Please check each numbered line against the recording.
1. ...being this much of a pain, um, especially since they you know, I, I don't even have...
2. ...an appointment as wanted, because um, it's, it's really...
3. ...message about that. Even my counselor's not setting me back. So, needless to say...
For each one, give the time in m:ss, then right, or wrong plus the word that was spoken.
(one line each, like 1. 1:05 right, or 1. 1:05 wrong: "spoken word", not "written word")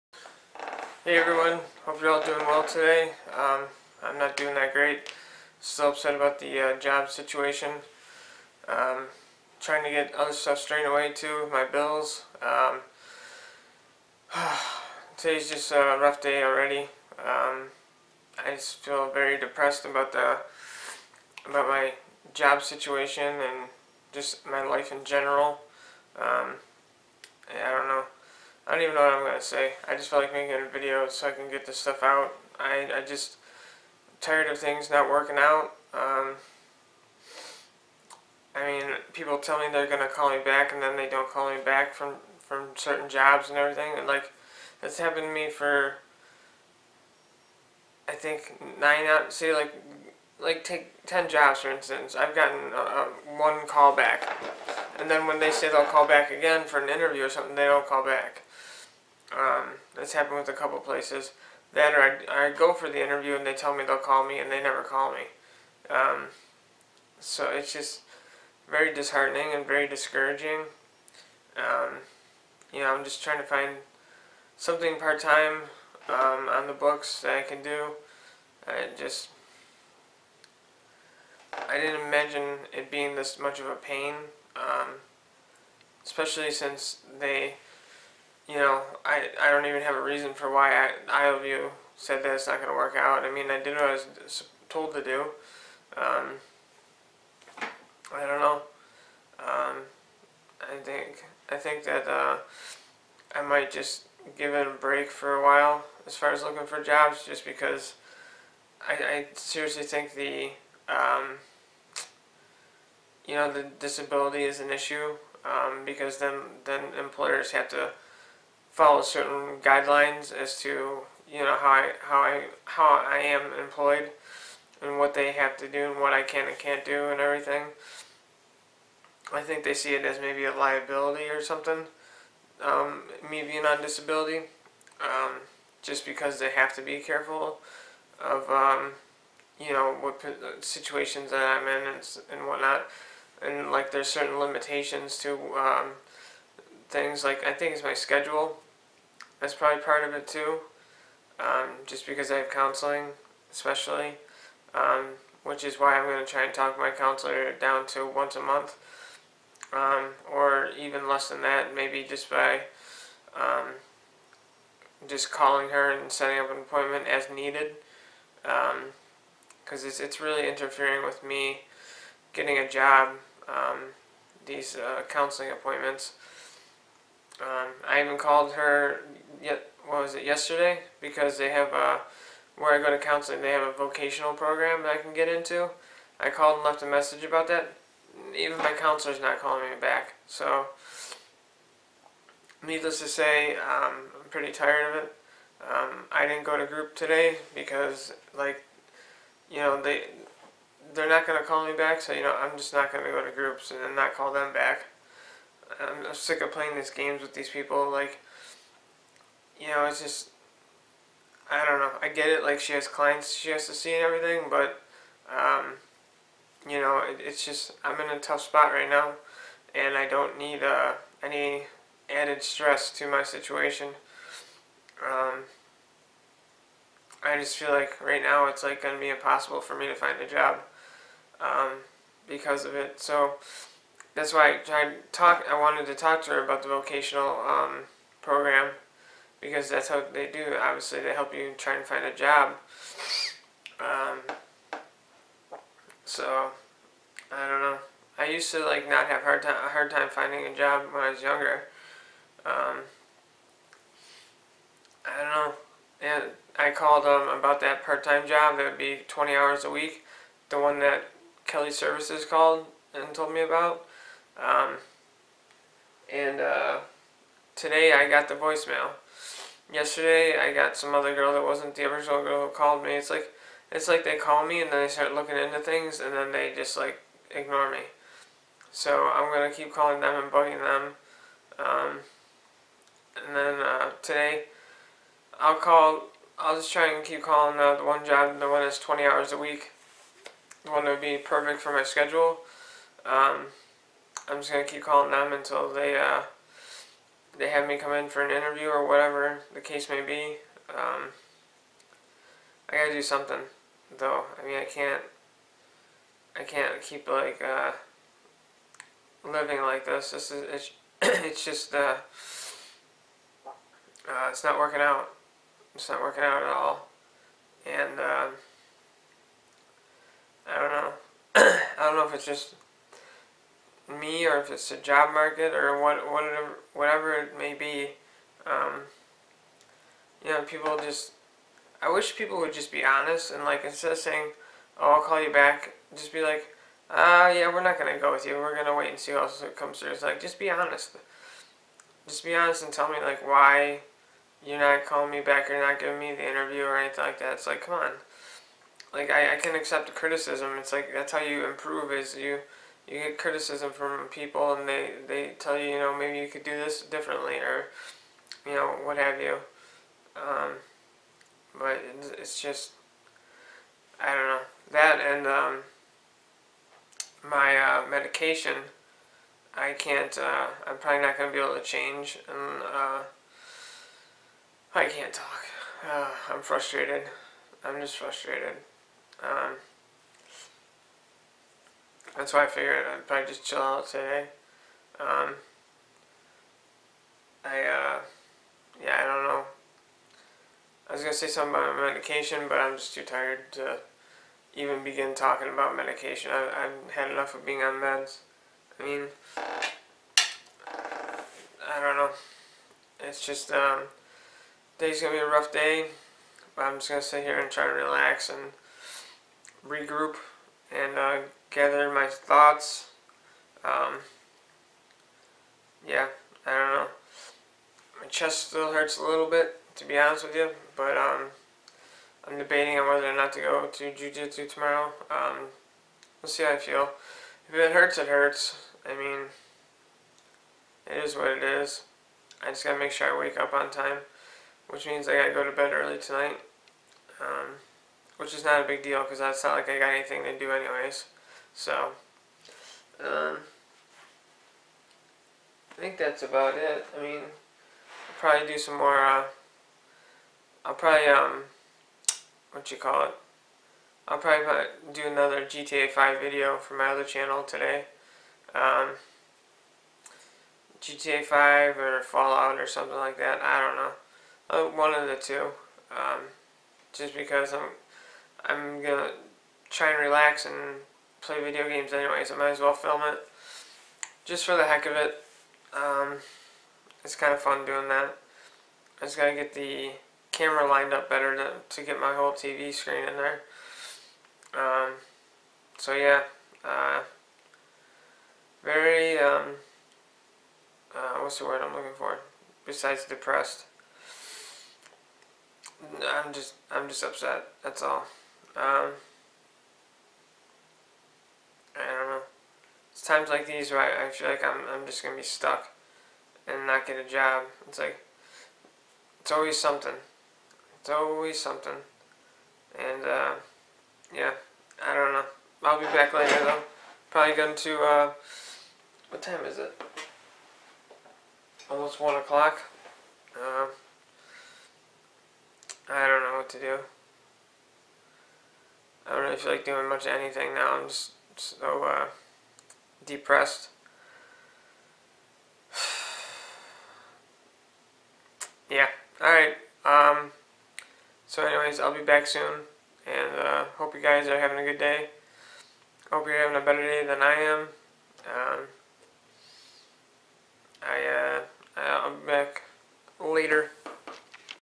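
1. 1:22 right
2. 2:46 wrong: "needed", not "wanted"
3. 3:06 wrong: "calling", not "setting".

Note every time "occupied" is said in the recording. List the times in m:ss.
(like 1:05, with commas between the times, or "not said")
not said.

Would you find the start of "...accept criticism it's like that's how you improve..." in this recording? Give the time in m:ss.
5:49.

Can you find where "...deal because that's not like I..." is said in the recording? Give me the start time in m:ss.
7:18.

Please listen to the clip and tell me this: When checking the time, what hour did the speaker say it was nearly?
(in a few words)
1 o'clock.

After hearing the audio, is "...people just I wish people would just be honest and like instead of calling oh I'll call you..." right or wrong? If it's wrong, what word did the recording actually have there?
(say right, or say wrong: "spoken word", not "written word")
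wrong: "saying", not "calling".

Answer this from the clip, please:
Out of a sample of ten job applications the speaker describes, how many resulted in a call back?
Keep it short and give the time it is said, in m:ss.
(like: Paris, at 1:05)
1, at 0:53.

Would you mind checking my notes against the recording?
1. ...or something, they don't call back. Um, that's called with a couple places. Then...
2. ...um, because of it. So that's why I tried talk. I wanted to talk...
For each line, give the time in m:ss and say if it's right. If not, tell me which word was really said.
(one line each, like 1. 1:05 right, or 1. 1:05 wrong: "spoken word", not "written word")
1. 0:57 wrong: "happened", not "called"
2. 3:51 right.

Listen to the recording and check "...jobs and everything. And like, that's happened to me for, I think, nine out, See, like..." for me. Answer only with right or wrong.
right.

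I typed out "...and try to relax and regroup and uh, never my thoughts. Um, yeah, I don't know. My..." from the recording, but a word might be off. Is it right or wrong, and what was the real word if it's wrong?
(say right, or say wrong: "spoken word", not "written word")
wrong: "gather", not "never".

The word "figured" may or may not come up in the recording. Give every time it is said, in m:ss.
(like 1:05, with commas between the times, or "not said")
6:22.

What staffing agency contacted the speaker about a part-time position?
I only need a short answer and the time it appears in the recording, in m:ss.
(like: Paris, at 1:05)
Kelly Services, at 4:21.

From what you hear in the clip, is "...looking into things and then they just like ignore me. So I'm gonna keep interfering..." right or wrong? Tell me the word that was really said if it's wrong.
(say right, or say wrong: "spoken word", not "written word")
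wrong: "calling", not "interfering".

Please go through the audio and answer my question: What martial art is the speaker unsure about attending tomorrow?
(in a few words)
jujitsu.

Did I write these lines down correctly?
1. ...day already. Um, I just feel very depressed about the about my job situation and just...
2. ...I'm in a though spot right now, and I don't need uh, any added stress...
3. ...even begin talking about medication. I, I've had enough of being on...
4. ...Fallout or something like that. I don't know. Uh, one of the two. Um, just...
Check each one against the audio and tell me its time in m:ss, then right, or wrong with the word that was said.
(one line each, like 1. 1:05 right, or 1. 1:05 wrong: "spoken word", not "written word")
1. 0:16 right
2. 3:37 wrong: "tough", not "though"
3. 6:34 right
4. 7:42 right.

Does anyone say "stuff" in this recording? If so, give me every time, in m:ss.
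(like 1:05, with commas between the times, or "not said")
0:10, 0:31.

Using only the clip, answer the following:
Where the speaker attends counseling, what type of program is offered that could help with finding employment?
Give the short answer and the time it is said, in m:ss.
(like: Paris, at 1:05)
vocational program, at 3:03.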